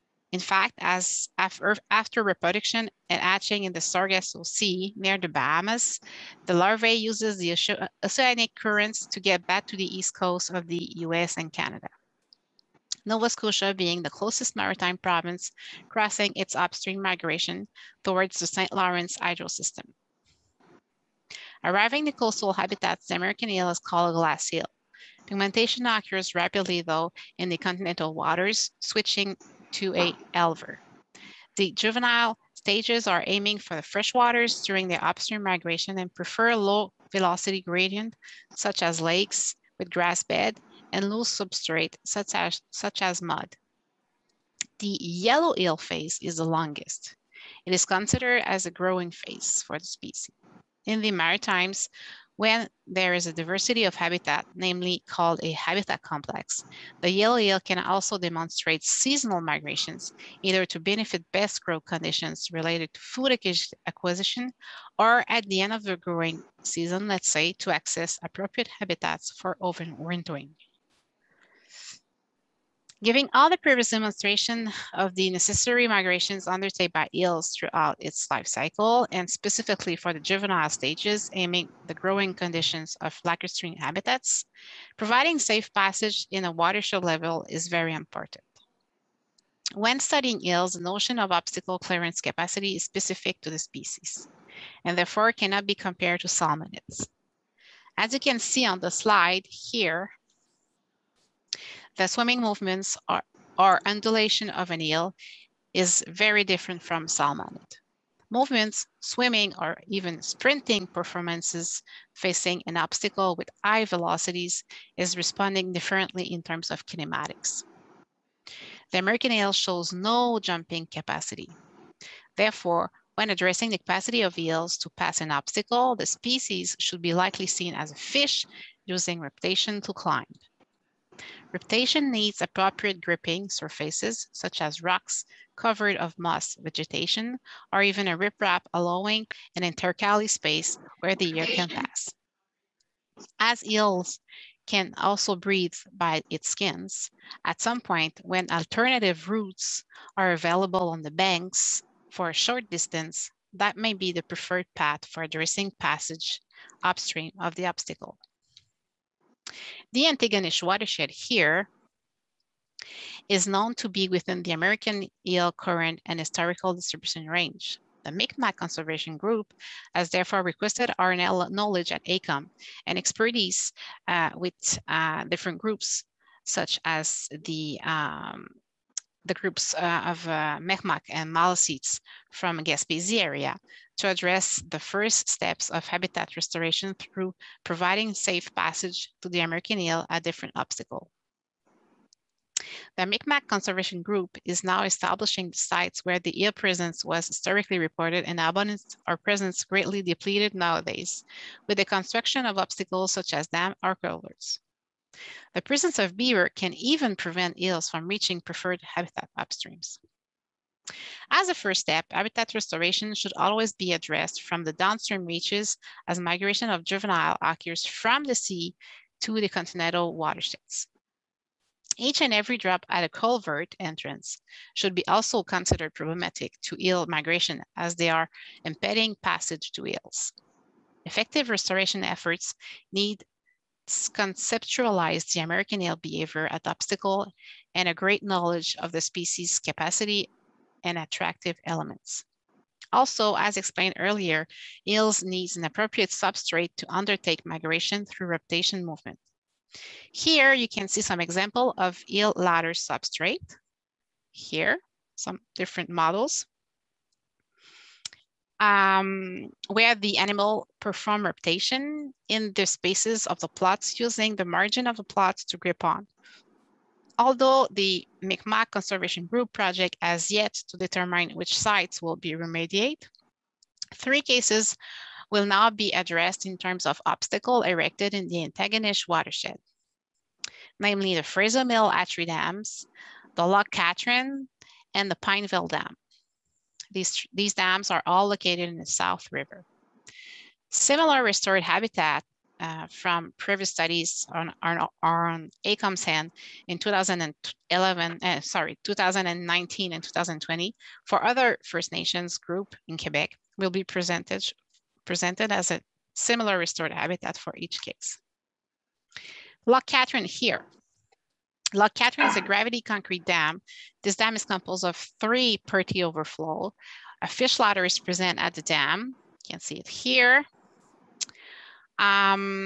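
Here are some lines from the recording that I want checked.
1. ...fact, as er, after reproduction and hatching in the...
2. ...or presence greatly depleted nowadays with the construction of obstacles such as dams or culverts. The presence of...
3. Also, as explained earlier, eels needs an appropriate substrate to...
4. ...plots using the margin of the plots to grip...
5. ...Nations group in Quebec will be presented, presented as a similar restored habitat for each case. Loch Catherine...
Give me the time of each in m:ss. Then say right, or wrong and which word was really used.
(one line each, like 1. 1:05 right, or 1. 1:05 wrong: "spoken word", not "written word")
1. 0:00 right
2. 3:19 right
3. 4:02 right
4. 4:23 right
5. 5:01 right.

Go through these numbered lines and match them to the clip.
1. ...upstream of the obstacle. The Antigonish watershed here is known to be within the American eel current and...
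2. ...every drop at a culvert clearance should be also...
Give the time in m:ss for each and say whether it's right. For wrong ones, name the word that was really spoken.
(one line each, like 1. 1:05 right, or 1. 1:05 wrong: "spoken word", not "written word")
1. 2:36 right
2. 3:42 wrong: "entrance", not "clearance".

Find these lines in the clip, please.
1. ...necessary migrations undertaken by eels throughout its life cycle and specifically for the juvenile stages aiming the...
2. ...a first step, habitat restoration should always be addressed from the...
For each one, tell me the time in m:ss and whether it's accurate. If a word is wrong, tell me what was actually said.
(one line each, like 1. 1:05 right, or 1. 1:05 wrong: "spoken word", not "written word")
1. 1:15 right
2. 3:31 right.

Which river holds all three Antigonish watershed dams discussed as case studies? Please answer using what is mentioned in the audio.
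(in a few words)
South River.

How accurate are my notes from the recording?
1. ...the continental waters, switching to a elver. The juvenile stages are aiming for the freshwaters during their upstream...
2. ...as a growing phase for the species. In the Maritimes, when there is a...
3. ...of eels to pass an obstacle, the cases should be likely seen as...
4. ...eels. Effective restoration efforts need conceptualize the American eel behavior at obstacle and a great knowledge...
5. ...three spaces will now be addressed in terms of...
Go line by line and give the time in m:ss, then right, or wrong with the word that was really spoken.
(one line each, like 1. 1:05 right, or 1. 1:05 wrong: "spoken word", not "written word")
1. 0:27 right
2. 0:48 right
3. 2:04 wrong: "species", not "cases"
4. 3:49 right
5. 4:33 wrong: "cases", not "spaces".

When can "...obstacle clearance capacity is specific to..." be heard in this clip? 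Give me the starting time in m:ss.
1:31.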